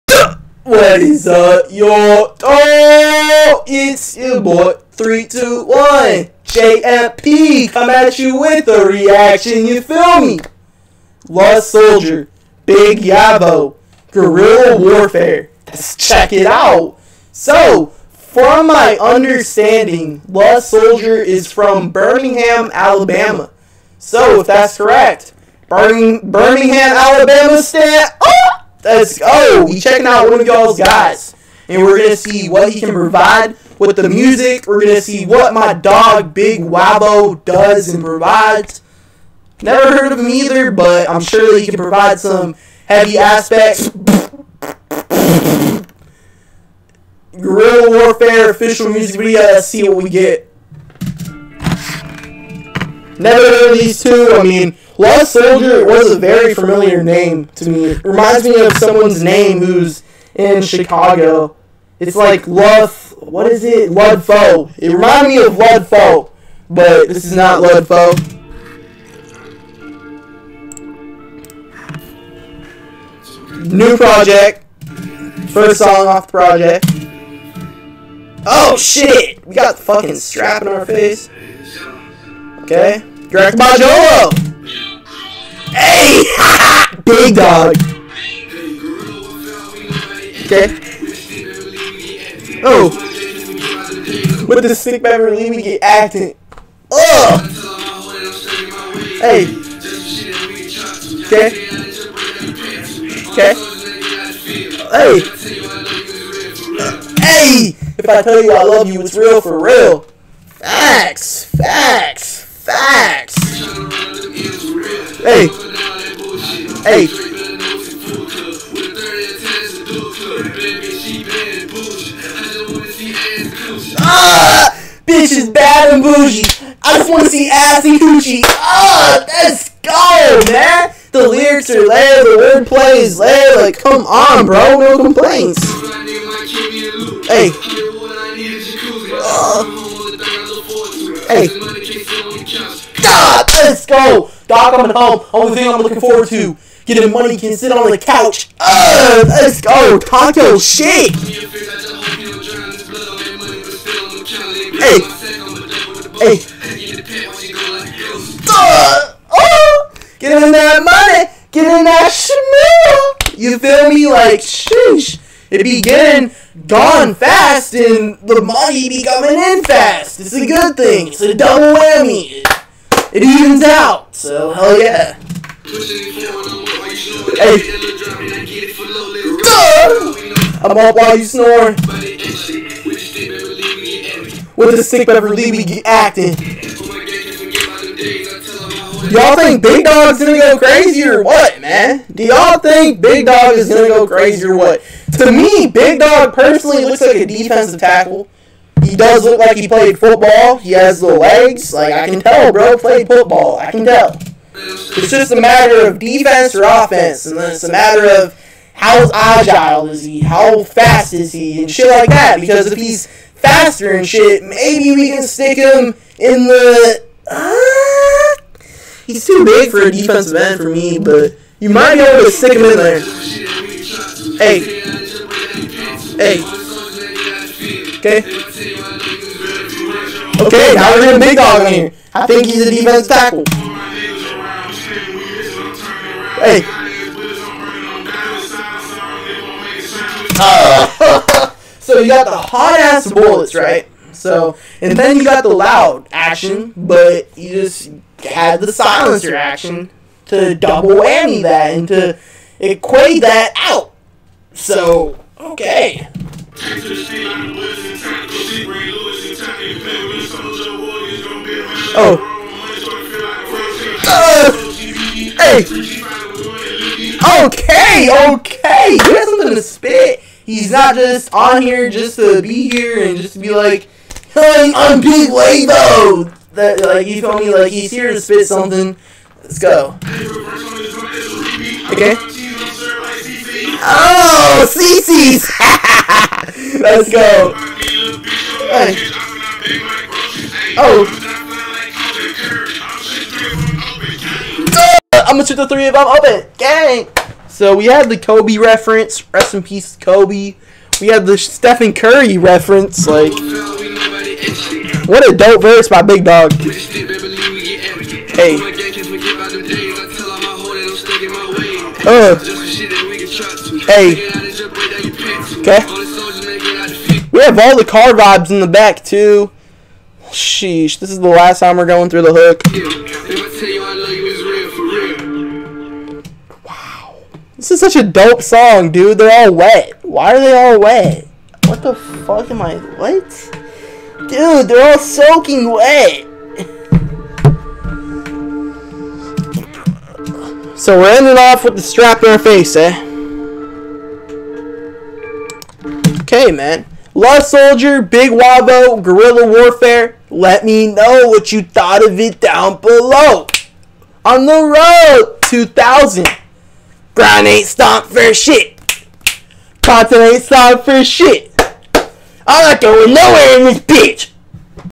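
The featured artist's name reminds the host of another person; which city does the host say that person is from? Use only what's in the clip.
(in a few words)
Chicago.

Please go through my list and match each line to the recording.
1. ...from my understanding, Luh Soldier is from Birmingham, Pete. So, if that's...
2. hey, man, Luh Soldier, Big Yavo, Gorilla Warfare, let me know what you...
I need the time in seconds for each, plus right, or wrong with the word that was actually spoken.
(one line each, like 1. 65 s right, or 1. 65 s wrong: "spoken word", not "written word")
1. 18 s wrong: "Alabama", not "Pete"
2. 346 s right.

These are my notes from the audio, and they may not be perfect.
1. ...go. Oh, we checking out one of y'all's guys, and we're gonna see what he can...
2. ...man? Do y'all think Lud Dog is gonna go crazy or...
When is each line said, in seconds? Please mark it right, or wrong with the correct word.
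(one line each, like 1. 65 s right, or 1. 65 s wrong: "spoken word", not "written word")
1. 29 s right
2. 191 s wrong: "Big", not "Lud".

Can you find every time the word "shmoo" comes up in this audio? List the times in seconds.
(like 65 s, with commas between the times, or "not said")
162 s.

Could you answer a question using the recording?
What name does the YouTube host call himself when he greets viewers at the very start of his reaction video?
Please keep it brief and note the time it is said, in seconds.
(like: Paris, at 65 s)
321 JMP, at 4 s.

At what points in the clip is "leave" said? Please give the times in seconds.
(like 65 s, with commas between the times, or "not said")
95 s, 185 s.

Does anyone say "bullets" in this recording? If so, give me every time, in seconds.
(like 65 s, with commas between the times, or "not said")
243 s.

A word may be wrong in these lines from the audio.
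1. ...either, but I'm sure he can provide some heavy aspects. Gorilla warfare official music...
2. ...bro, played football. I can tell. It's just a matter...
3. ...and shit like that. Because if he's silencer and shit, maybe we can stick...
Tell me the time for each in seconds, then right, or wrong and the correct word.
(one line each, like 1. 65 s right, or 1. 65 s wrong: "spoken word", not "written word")
1. 40 s right
2. 202 s right
3. 211 s wrong: "faster", not "silencer".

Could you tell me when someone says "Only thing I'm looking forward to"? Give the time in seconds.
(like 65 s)
145 s.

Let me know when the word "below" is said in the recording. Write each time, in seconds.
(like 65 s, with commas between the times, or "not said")
352 s.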